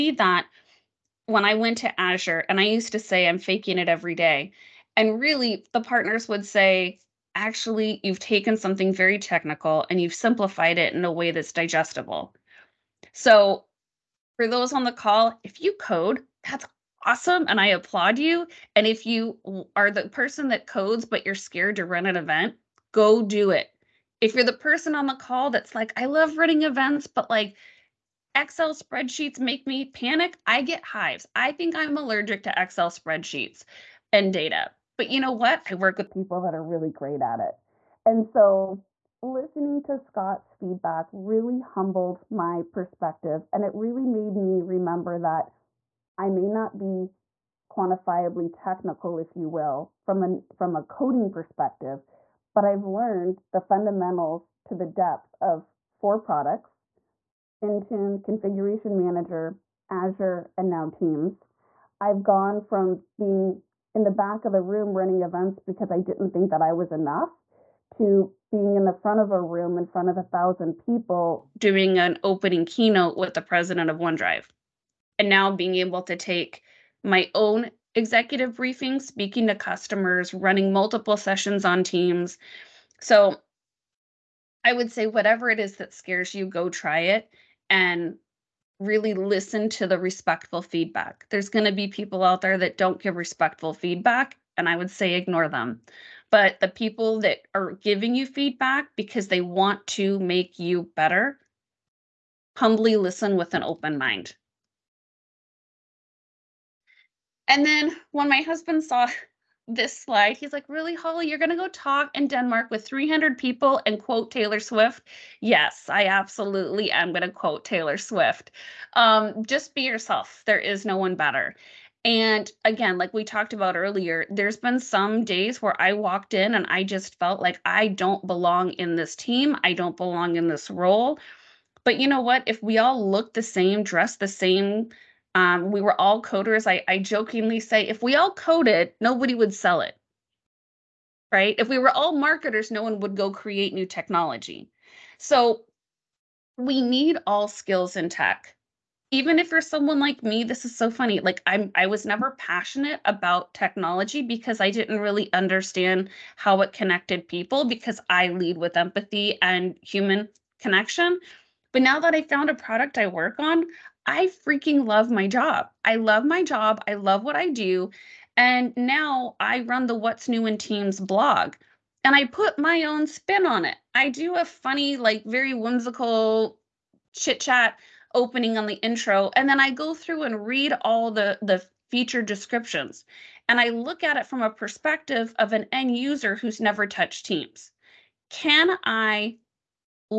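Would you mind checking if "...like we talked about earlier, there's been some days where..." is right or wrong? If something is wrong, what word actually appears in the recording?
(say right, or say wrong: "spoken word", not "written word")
right.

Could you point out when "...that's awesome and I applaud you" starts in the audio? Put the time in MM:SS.
00:16.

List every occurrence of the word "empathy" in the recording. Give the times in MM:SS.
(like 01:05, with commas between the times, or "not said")
02:38.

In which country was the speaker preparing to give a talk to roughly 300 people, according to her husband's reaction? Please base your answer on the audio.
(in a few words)
Denmark.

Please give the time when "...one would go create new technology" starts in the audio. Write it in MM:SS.
02:22.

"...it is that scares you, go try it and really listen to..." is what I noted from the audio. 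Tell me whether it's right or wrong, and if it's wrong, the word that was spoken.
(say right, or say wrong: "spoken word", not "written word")
right.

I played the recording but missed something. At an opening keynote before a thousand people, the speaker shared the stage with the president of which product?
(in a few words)
OneDrive.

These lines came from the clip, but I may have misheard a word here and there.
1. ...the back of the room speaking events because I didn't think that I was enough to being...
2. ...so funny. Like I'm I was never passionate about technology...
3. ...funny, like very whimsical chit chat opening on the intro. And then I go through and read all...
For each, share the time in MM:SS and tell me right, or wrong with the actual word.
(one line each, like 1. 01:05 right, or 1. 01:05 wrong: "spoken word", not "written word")
1. 01:04 wrong: "running", not "speaking"
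2. 02:30 right
3. 02:54 right.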